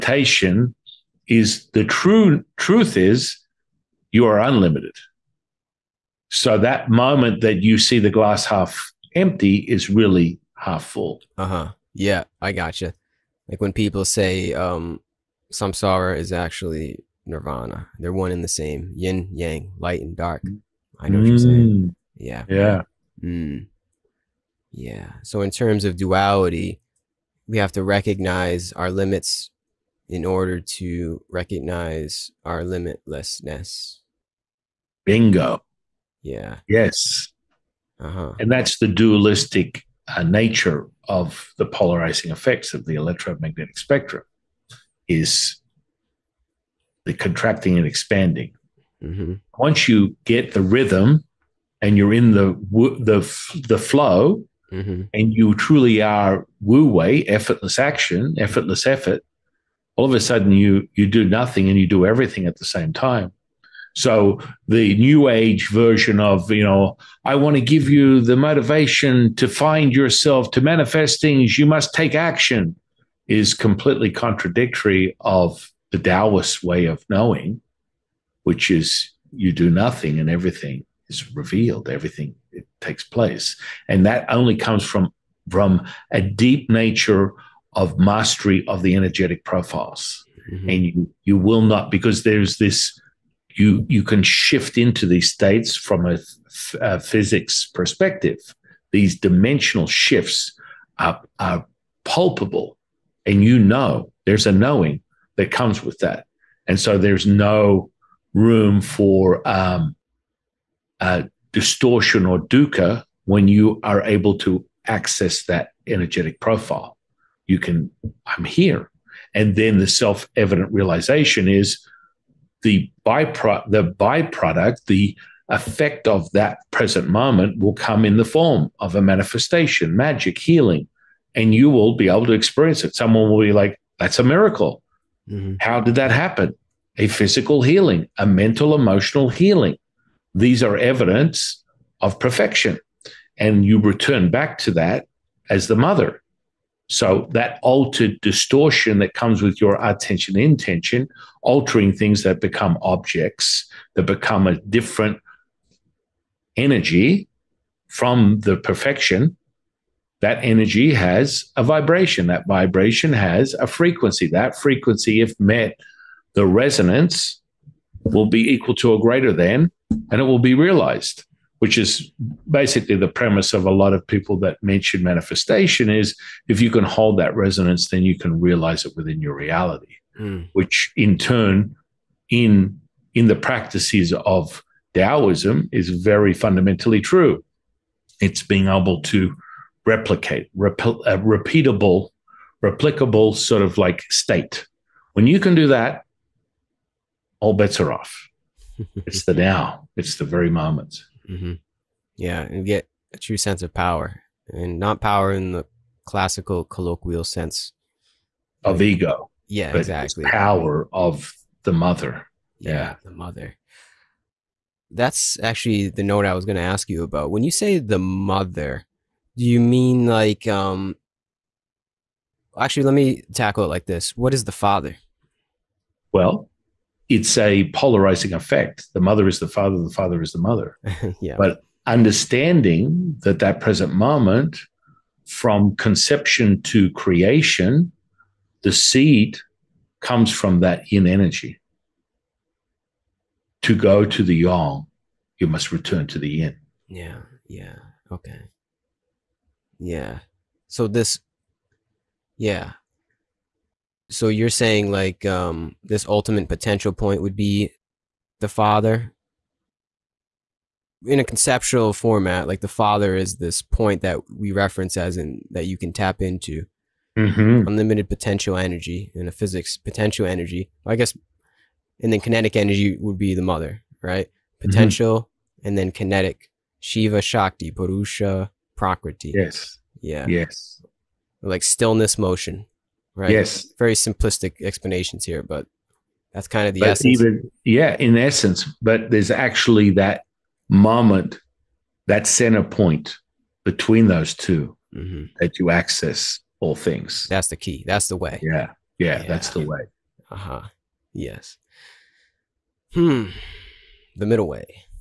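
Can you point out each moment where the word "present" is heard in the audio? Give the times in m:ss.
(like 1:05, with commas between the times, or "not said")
2:06, 3:53.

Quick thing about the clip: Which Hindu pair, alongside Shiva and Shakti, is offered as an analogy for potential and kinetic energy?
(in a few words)
Purusha Prakriti.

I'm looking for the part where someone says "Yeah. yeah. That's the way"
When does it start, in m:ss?
4:58.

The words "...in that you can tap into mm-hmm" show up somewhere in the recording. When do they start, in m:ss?
4:25.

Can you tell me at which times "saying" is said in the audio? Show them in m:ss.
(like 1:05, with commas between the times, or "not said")
0:21, 4:14.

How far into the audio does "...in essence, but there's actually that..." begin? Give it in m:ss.
4:47.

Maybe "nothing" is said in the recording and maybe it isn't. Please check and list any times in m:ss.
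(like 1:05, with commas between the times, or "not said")
1:01, 1:19.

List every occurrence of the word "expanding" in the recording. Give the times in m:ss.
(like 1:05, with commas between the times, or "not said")
0:47.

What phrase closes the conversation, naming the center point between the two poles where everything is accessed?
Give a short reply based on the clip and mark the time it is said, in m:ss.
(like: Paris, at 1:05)
The middle way, at 5:04.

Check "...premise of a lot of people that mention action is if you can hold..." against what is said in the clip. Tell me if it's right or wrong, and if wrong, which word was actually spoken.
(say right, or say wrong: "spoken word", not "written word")
wrong: "manifestation", not "action".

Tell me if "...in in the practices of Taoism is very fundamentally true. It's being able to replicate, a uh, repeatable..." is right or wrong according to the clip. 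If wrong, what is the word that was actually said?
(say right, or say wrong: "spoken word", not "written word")
right.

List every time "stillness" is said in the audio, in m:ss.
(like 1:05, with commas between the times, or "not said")
4:41.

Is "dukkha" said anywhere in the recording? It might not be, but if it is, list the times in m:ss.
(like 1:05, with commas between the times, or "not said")
1:52.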